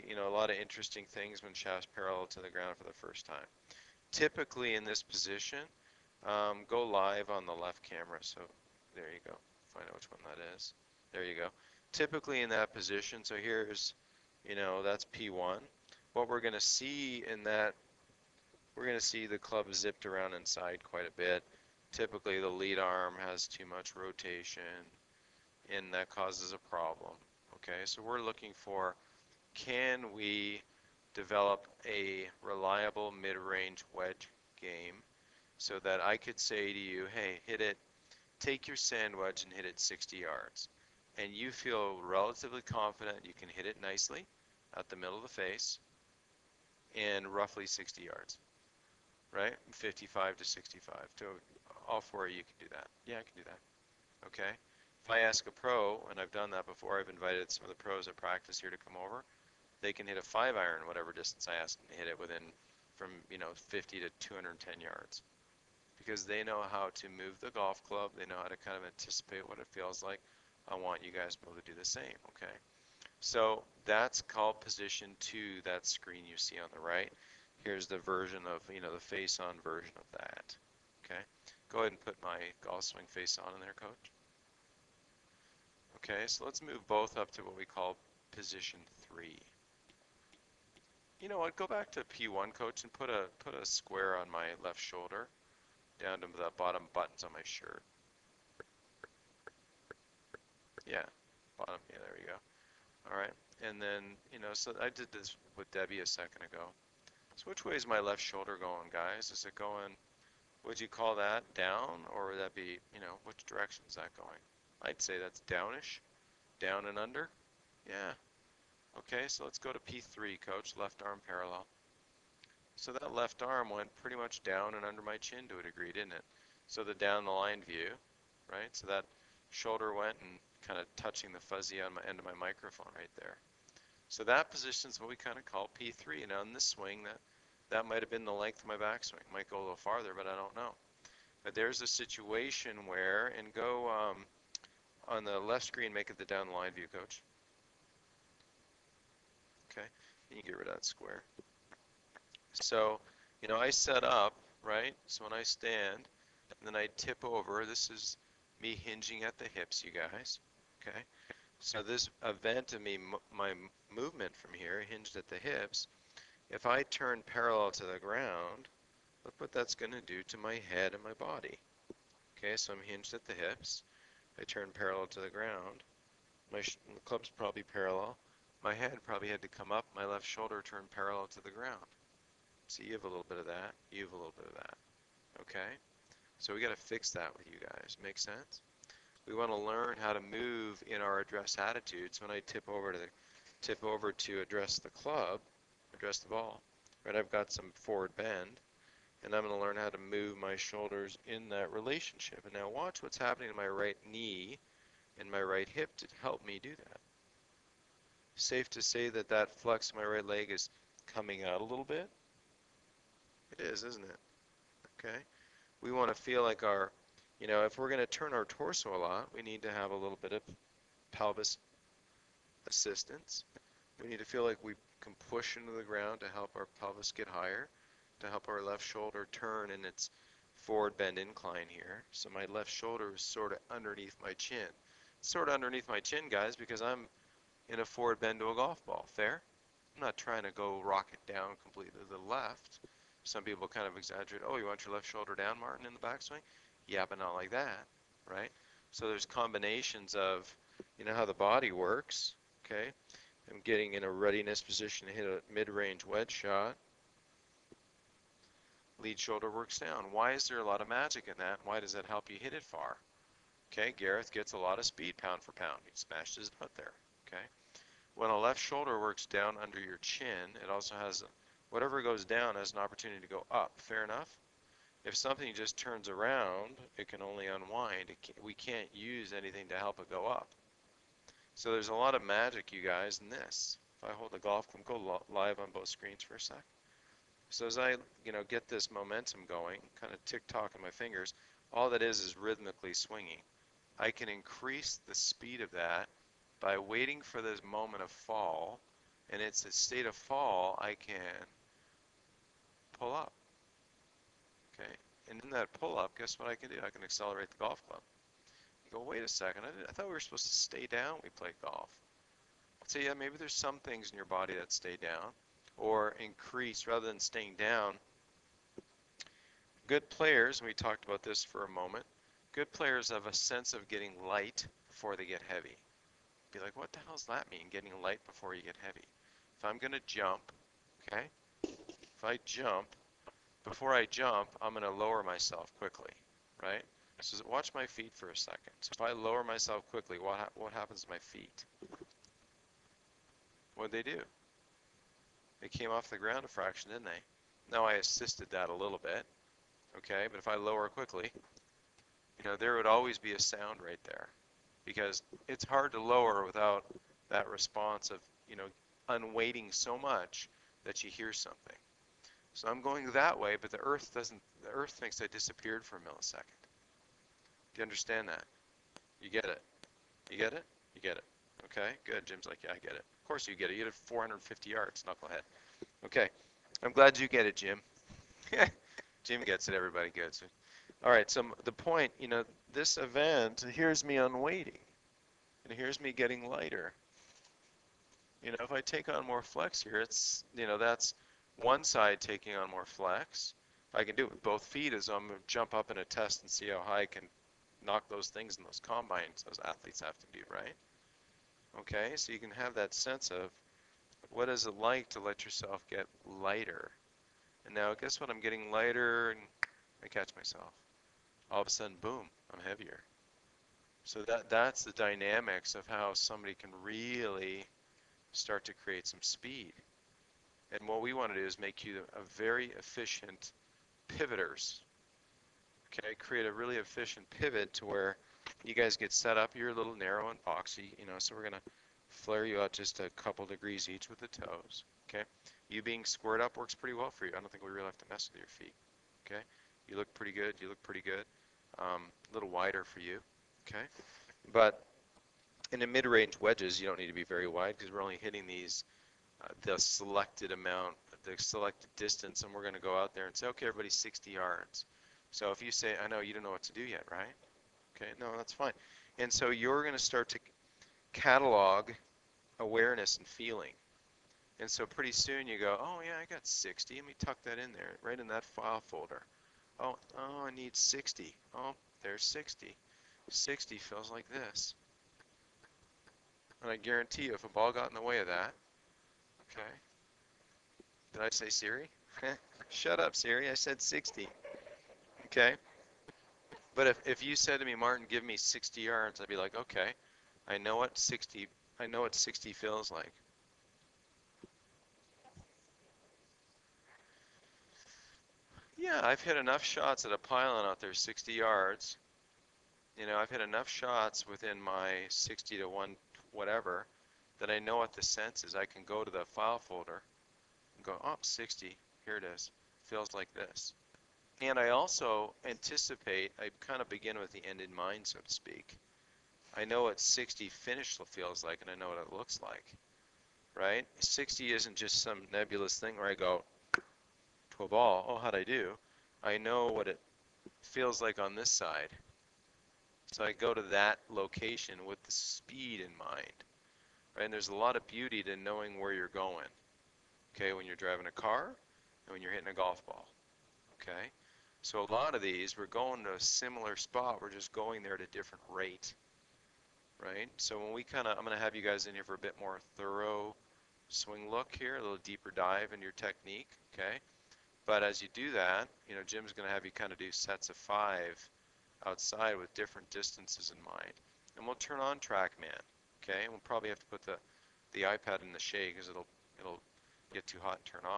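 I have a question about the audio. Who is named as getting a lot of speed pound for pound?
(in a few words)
Gareth.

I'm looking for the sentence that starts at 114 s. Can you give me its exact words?
I'd say that's downish, down and under.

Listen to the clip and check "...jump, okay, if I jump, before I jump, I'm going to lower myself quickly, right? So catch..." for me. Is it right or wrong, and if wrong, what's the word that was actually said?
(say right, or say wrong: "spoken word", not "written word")
wrong: "watch", not "catch".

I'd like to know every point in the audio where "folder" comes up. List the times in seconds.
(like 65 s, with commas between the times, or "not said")
468 s, 509 s.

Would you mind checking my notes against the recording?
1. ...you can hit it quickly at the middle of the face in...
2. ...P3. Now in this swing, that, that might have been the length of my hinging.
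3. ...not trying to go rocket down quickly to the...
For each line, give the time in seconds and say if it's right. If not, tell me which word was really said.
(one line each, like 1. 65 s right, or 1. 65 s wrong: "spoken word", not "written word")
1. 43 s wrong: "nicely", not "quickly"
2. 135 s wrong: "backswing", not "hinging"
3. 240 s wrong: "completely", not "quickly".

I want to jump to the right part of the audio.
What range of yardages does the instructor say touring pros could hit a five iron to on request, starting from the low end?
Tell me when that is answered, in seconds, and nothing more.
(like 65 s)
63 s.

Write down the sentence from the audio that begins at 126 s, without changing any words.
So the down the line view, right?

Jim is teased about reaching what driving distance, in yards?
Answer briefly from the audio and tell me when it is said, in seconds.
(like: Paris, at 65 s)
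450 yards, at 373 s.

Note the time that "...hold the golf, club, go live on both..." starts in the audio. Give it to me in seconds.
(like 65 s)
284 s.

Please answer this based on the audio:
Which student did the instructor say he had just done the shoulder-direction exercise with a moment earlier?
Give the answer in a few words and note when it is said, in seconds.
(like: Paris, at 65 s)
Debbie, at 105 s.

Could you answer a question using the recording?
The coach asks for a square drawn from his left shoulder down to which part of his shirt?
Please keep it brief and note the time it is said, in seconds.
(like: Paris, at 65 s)
bottom buttons, at 96 s.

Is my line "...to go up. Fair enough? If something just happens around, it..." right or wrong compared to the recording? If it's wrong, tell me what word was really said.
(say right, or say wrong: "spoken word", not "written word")
wrong: "turns", not "happens".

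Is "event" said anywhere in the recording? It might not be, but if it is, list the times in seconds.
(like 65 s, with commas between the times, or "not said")
162 s, 382 s.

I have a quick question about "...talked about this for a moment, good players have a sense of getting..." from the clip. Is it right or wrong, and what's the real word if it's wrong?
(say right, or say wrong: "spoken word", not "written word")
right.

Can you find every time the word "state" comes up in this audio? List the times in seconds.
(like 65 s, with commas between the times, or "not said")
299 s.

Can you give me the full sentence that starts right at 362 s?
So I'm going that way, but the Earth doesn't.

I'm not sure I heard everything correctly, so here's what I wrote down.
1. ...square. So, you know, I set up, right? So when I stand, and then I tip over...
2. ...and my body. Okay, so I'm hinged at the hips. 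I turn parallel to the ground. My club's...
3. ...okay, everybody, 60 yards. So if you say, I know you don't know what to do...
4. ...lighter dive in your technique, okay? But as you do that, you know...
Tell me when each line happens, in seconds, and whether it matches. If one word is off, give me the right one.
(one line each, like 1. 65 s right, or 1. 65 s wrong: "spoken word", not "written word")
1. 150 s right
2. 170 s right
3. 453 s right
4. 554 s wrong: "deeper", not "lighter".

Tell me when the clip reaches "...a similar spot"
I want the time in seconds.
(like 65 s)
546 s.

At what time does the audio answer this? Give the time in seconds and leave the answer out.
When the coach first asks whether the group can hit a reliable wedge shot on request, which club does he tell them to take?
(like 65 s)
38 s.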